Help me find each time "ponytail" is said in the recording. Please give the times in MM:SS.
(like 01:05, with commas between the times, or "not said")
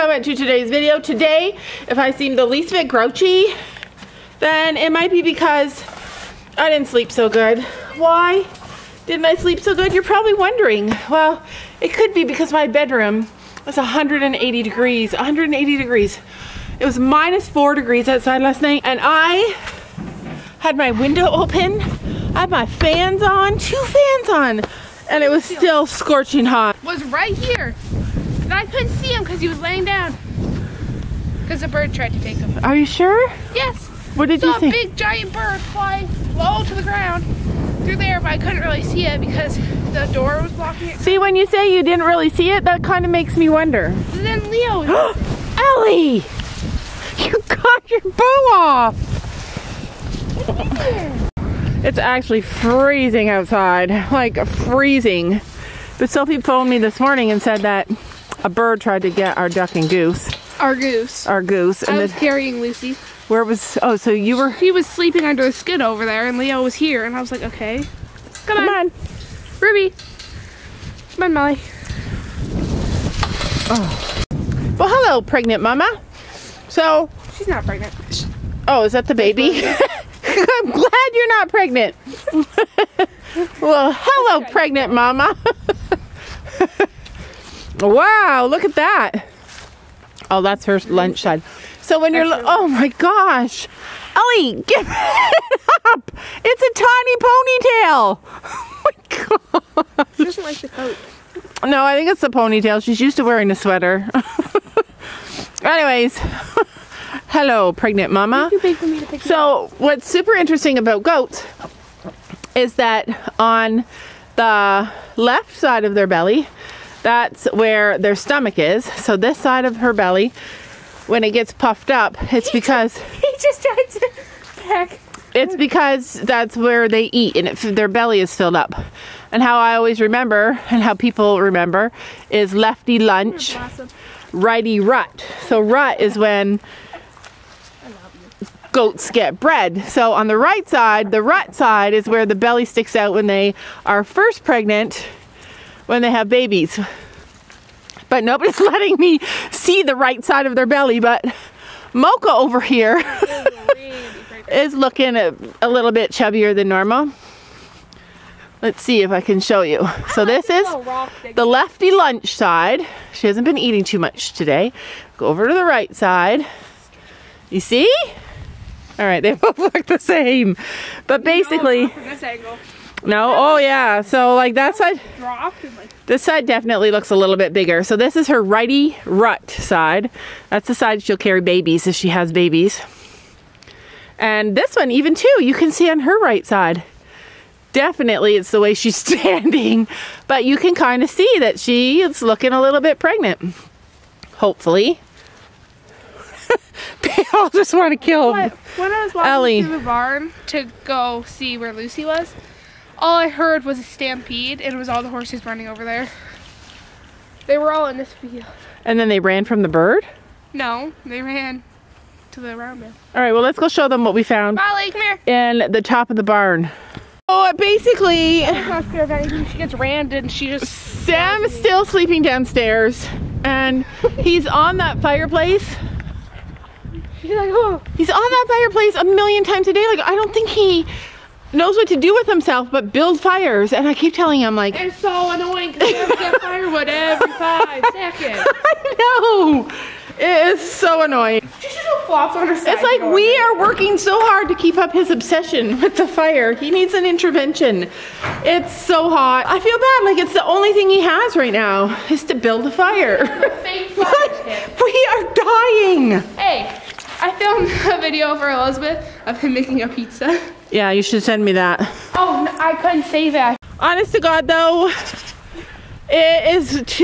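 01:37, 01:42.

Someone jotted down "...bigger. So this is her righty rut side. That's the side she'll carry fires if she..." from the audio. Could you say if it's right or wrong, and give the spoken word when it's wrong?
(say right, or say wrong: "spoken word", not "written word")
wrong: "babies", not "fires".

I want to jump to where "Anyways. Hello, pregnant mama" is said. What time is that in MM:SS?
01:45.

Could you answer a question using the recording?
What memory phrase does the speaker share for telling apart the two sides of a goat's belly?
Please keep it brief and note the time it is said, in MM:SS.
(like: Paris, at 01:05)
lefty lunch, righty rut, at 02:12.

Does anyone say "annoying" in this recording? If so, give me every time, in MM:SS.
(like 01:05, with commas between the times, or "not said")
03:55, 04:01.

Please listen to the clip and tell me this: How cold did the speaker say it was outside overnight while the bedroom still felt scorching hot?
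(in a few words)
-4 degrees.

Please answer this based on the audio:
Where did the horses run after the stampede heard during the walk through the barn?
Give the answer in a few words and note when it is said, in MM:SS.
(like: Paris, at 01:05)
the round bin, at 03:32.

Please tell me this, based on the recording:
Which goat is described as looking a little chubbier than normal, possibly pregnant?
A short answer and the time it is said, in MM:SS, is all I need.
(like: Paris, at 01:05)
Mocha, at 02:31.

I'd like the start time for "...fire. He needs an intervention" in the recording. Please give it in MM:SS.
04:06.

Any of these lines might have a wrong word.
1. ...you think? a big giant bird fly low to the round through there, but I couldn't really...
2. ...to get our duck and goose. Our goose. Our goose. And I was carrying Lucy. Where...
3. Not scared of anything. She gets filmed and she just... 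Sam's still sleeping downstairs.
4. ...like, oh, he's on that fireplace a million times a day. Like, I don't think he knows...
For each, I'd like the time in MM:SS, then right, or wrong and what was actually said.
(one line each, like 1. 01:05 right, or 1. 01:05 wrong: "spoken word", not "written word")
1. 00:34 wrong: "ground", not "round"
2. 00:59 right
3. 03:38 wrong: "rammed", not "filmed"
4. 03:47 right.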